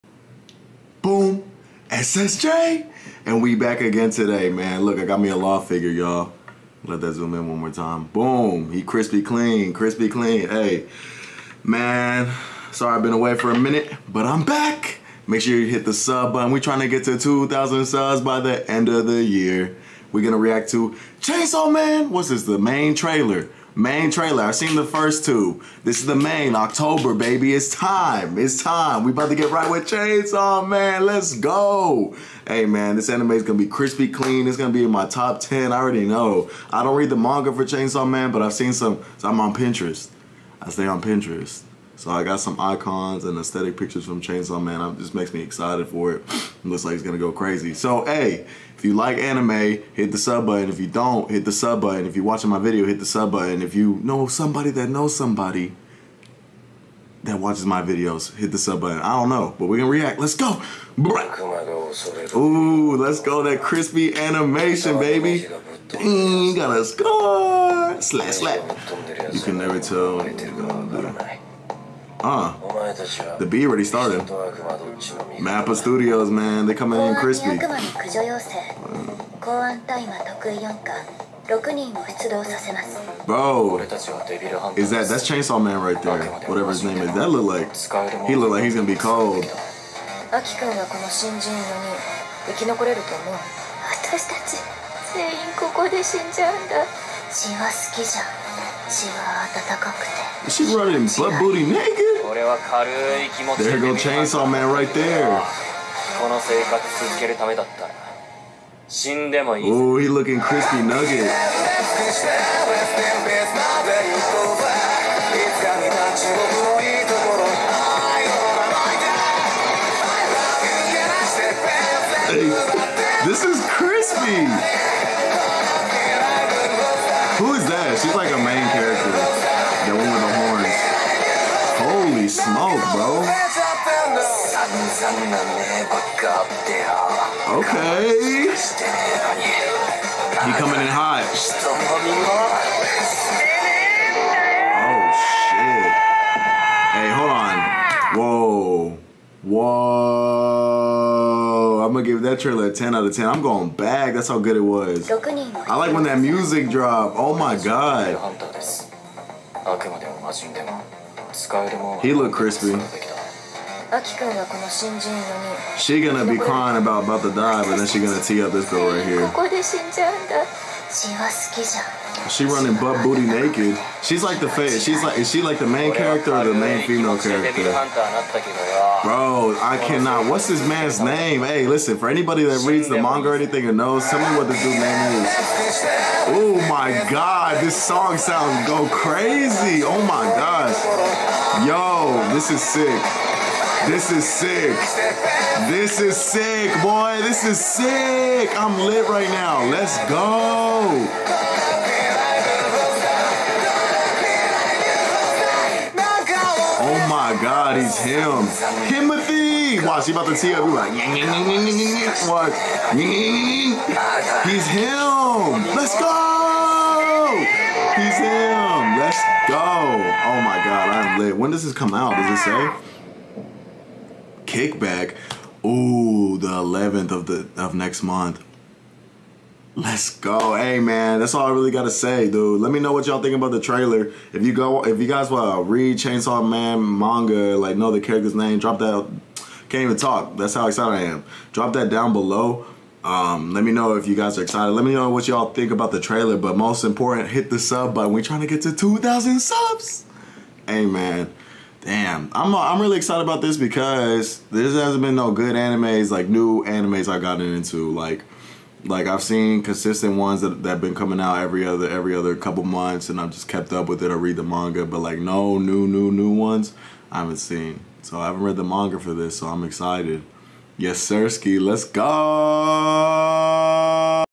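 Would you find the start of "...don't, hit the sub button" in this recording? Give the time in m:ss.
0:50.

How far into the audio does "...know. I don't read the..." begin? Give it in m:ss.
0:36.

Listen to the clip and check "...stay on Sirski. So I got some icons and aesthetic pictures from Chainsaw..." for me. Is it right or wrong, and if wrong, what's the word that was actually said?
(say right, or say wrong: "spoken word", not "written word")
wrong: "Pinterest", not "Sirski".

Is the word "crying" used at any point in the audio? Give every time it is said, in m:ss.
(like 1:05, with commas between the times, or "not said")
2:46.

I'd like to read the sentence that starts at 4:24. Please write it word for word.
I read the manga, but like no new new new ones I haven't seen.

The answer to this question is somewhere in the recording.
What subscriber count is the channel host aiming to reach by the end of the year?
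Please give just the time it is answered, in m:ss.
0:17.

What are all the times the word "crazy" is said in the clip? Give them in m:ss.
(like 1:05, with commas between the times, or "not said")
0:47, 3:08.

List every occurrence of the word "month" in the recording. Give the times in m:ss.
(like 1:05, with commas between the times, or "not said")
3:48, 4:22.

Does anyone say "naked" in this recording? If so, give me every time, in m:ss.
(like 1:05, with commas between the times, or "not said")
1:41, 2:53.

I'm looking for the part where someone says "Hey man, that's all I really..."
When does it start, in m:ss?
3:50.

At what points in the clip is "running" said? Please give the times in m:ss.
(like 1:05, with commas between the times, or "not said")
1:40, 2:52.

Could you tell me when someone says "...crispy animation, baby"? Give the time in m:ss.
1:03.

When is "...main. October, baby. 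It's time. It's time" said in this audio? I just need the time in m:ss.
0:26.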